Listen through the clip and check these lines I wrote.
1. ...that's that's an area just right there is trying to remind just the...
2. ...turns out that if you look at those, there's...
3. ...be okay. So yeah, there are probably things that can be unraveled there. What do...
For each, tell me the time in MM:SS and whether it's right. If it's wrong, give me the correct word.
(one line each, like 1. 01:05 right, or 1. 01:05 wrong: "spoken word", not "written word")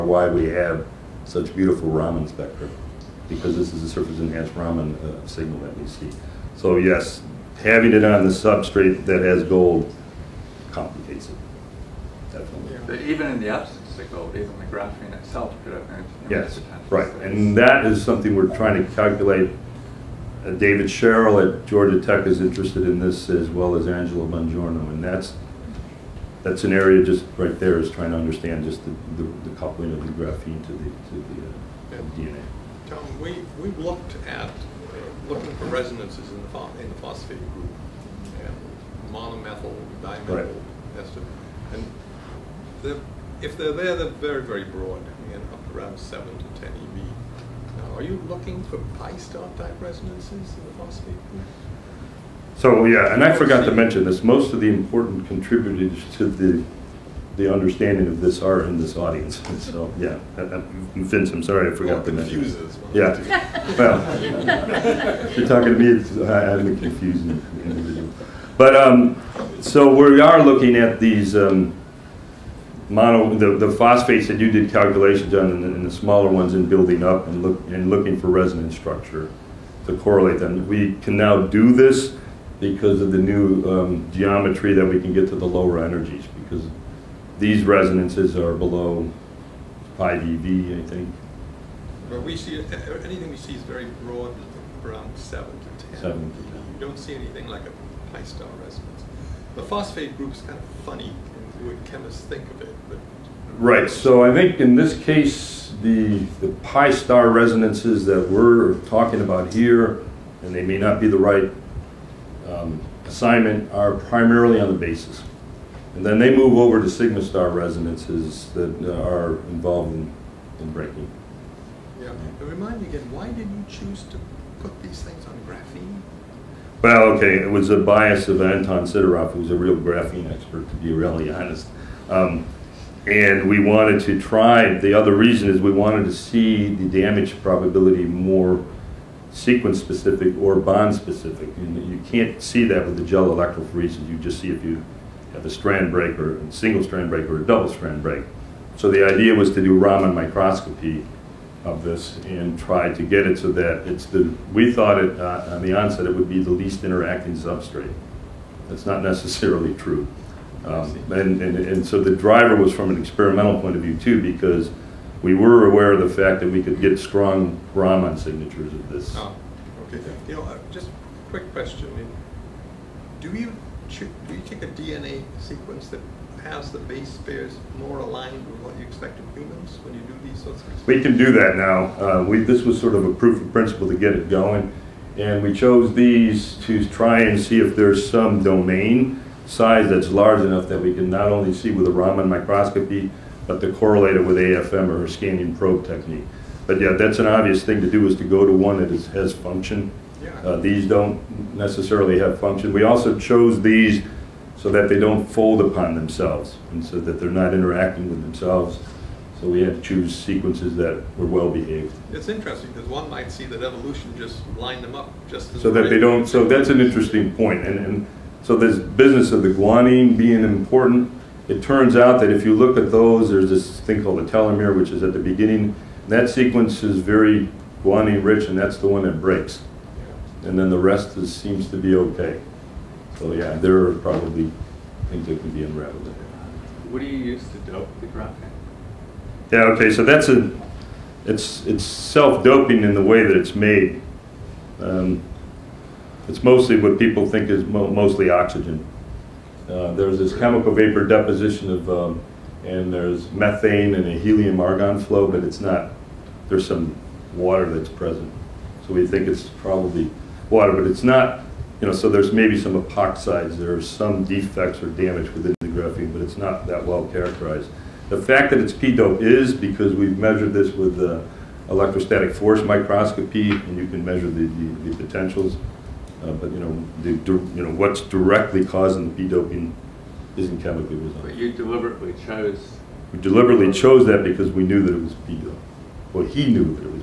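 1. 00:25 wrong: "understand", not "remind"
2. 03:41 right
3. 03:51 right.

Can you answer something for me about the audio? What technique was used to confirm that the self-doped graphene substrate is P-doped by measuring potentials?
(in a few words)
Electrostatic force microscopy.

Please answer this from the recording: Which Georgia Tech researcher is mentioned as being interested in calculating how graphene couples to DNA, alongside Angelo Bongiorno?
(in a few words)
David Sherrill.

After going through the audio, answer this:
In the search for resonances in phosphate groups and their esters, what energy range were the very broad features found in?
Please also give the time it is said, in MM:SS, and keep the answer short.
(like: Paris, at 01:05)
7 to 10 eV, at 00:45.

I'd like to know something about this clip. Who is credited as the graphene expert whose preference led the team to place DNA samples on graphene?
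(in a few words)
Anton Sidorov.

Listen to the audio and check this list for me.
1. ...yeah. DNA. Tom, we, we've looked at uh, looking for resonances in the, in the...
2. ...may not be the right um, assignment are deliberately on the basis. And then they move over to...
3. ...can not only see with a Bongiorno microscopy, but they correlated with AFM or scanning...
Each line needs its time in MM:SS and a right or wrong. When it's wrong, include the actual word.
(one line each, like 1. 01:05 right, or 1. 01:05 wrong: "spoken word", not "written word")
1. 00:32 right
2. 01:50 wrong: "primarily", not "deliberately"
3. 03:10 wrong: "Raman", not "Bongiorno".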